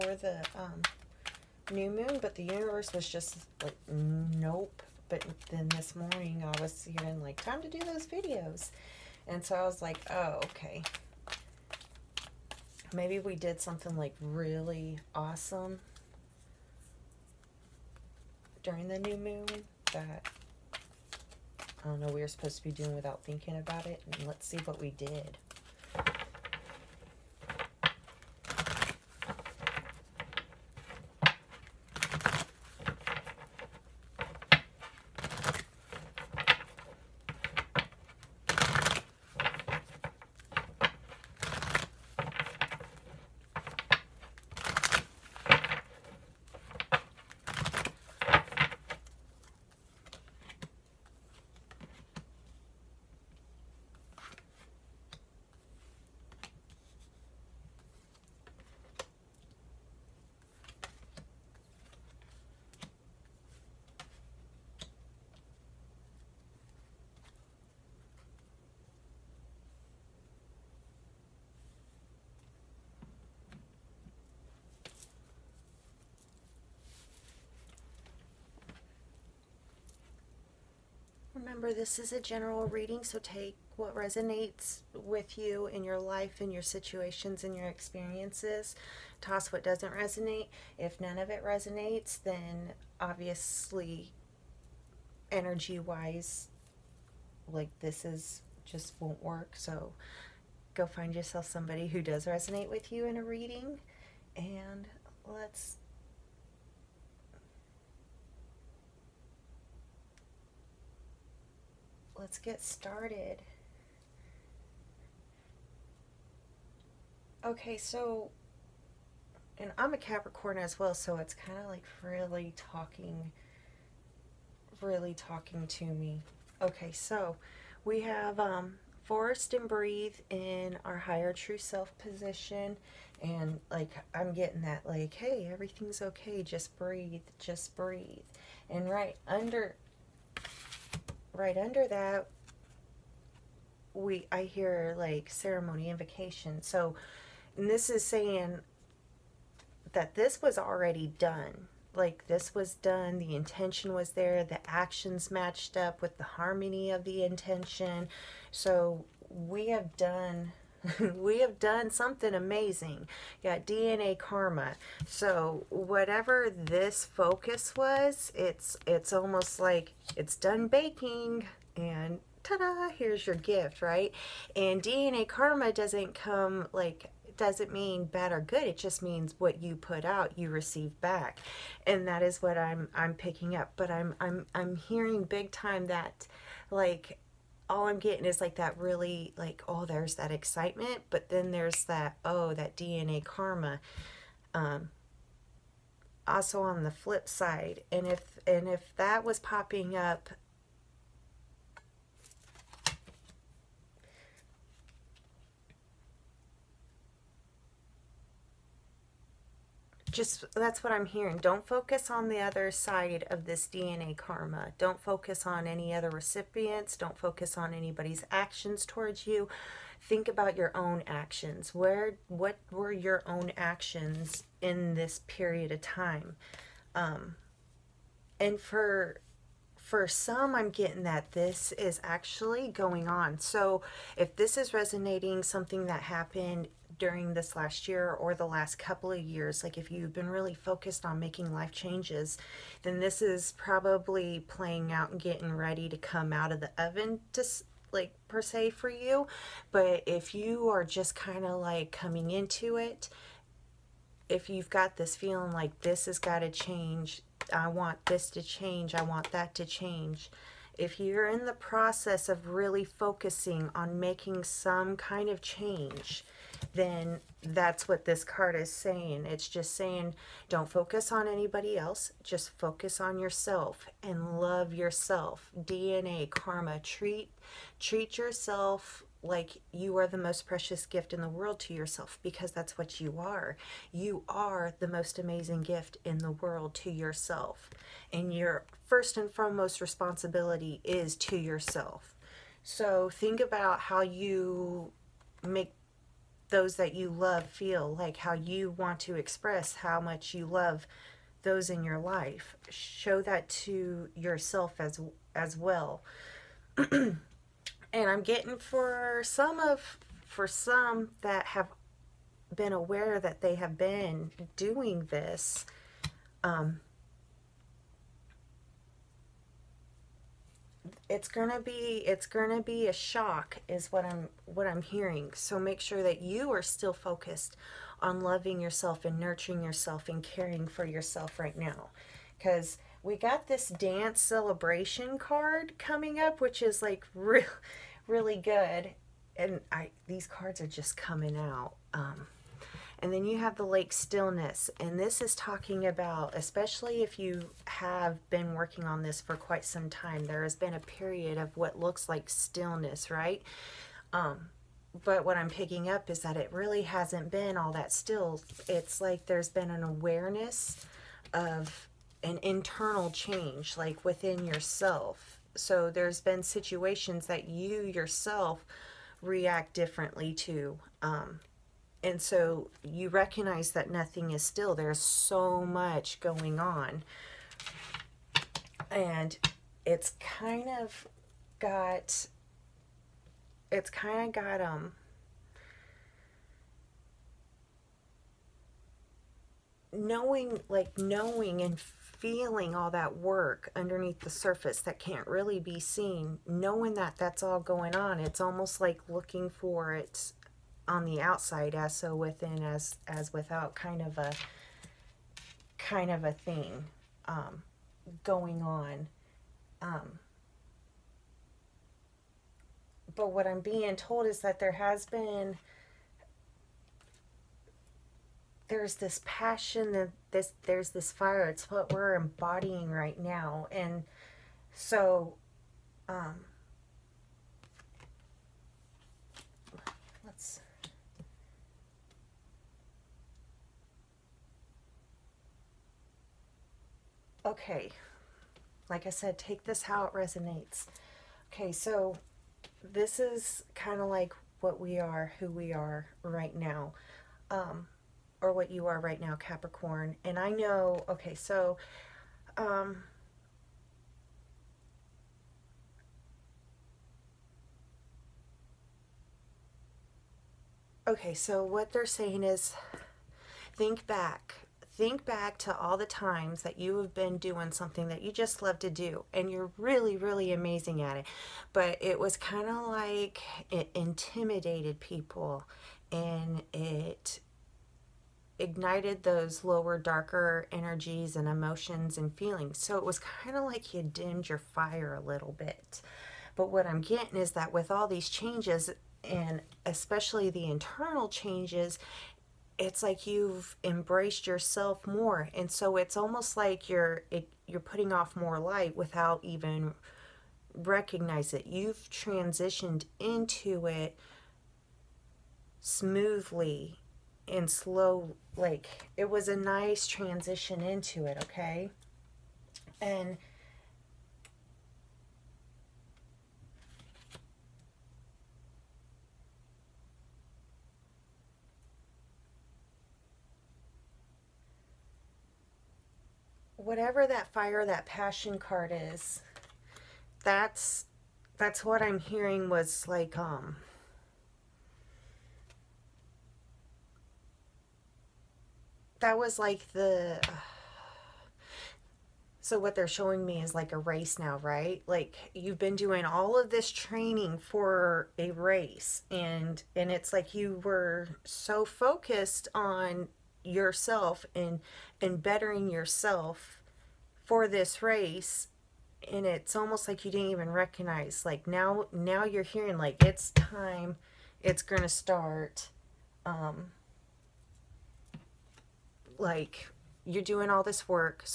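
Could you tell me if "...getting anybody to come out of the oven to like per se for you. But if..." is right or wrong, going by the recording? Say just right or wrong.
wrong.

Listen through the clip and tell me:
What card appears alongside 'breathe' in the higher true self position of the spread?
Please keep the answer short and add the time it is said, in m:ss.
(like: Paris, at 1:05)
Forest, at 2:09.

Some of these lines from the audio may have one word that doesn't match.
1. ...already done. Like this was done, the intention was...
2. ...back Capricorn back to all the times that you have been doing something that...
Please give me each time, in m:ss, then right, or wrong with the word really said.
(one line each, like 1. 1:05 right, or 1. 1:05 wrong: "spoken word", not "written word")
1. 2:30 right
2. 7:44 wrong: "Think", not "Capricorn".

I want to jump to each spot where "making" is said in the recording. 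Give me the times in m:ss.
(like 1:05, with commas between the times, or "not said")
4:01, 4:23.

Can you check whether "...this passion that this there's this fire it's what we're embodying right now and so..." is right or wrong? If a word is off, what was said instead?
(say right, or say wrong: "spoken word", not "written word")
right.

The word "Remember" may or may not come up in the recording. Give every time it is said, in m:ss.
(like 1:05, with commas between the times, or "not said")
1:21.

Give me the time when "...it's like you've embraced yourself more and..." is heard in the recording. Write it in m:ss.
8:12.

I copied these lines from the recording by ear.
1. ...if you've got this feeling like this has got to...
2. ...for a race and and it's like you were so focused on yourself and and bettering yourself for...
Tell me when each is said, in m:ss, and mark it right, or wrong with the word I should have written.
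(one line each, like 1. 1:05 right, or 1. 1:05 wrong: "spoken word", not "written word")
1. 4:14 right
2. 9:07 right.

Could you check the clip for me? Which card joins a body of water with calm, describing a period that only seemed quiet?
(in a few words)
Lake stillness.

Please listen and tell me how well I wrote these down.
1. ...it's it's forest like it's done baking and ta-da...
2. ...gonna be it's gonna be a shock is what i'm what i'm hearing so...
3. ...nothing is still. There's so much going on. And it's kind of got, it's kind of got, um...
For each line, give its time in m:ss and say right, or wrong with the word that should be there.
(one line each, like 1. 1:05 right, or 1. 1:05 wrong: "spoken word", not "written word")
1. 2:48 wrong: "almost", not "forest"
2. 5:21 right
3. 6:13 right.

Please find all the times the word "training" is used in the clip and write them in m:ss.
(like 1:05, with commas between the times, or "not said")
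9:06.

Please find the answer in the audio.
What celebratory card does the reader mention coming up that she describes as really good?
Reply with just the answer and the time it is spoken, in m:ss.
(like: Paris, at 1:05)
Dance celebration, at 5:33.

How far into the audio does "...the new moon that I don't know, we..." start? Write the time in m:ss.
0:18.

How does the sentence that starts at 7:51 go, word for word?
But it was kind of like it intimidated people and it ignited those lower, darker energies and emotions and feelings.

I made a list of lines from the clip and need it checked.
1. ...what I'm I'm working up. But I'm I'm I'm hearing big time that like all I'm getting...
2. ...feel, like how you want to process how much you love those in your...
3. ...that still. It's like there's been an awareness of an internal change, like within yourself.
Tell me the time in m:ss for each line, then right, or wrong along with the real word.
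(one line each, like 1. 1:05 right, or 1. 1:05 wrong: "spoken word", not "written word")
1. 3:02 wrong: "picking", not "working"
2. 4:57 wrong: "express", not "process"
3. 5:57 right.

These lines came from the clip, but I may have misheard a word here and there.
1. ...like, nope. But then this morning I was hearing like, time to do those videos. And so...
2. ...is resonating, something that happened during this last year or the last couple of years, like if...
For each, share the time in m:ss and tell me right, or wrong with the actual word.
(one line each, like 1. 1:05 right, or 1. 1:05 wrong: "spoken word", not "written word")
1. 0:03 right
2. 3:54 right.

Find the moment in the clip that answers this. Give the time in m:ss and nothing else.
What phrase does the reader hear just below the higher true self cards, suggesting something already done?
2:25.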